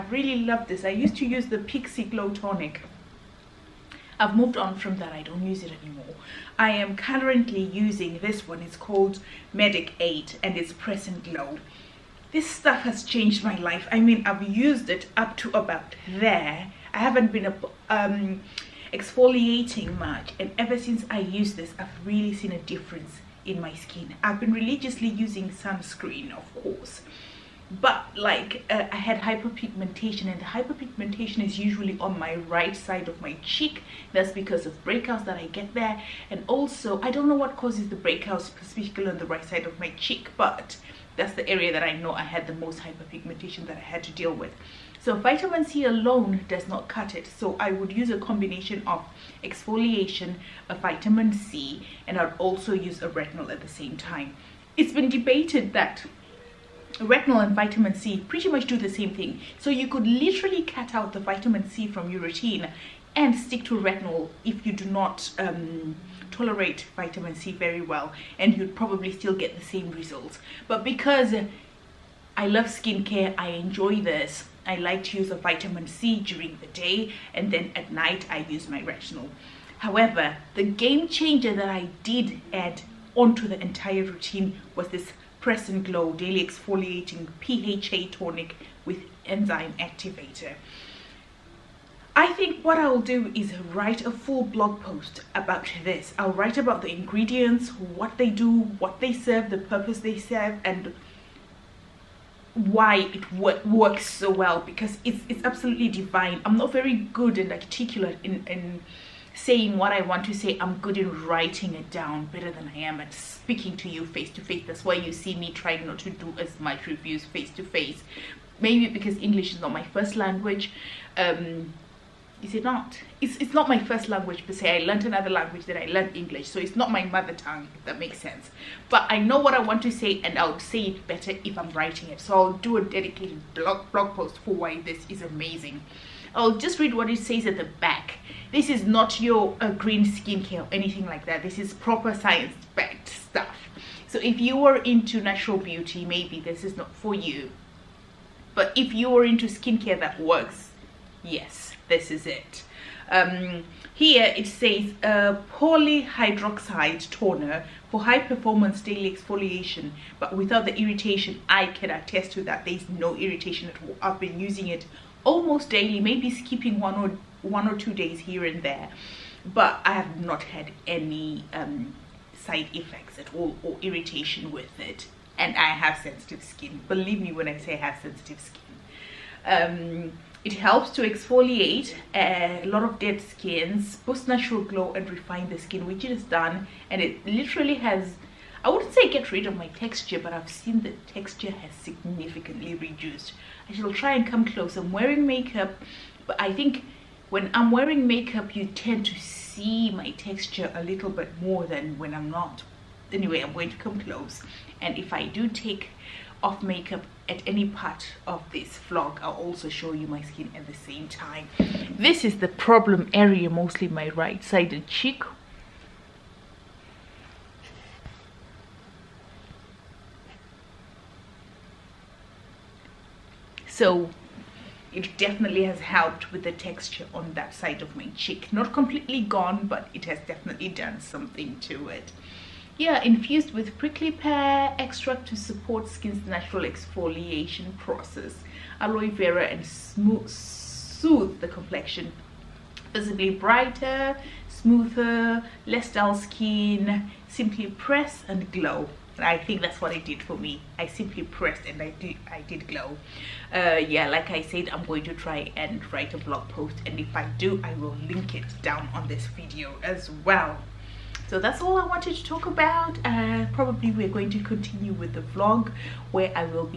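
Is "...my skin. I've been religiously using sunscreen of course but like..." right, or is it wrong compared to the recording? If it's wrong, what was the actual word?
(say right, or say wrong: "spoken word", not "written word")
right.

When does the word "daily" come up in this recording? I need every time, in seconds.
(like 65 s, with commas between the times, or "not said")
86 s, 158 s, 165 s.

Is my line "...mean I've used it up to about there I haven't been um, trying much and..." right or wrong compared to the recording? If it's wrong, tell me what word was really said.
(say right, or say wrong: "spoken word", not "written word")
wrong: "exfoliating", not "trying".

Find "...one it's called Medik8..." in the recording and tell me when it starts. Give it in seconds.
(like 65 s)
8 s.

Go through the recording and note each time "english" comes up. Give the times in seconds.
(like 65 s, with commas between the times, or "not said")
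119 s, 126 s.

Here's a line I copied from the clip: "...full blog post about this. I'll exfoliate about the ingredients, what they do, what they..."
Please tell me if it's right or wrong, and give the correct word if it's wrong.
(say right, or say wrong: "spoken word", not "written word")
wrong: "write", not "exfoliate".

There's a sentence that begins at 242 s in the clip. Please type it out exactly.
Visibly brighter, smoother, less dull skin.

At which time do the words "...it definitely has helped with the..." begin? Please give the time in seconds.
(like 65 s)
224 s.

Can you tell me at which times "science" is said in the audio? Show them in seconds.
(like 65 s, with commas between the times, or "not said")
142 s.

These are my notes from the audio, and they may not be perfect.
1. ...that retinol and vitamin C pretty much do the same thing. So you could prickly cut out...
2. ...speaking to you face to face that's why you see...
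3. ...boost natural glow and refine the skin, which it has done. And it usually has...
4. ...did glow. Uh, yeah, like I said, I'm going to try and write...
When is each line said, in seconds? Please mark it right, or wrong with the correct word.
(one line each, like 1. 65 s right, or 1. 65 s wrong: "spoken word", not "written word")
1. 55 s wrong: "literally", not "prickly"
2. 113 s right
3. 183 s wrong: "literally", not "usually"
4. 252 s right.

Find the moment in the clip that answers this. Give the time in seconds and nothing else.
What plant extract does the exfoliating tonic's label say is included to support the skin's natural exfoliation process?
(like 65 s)
233 s.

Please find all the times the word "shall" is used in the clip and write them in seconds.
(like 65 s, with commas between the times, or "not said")
193 s.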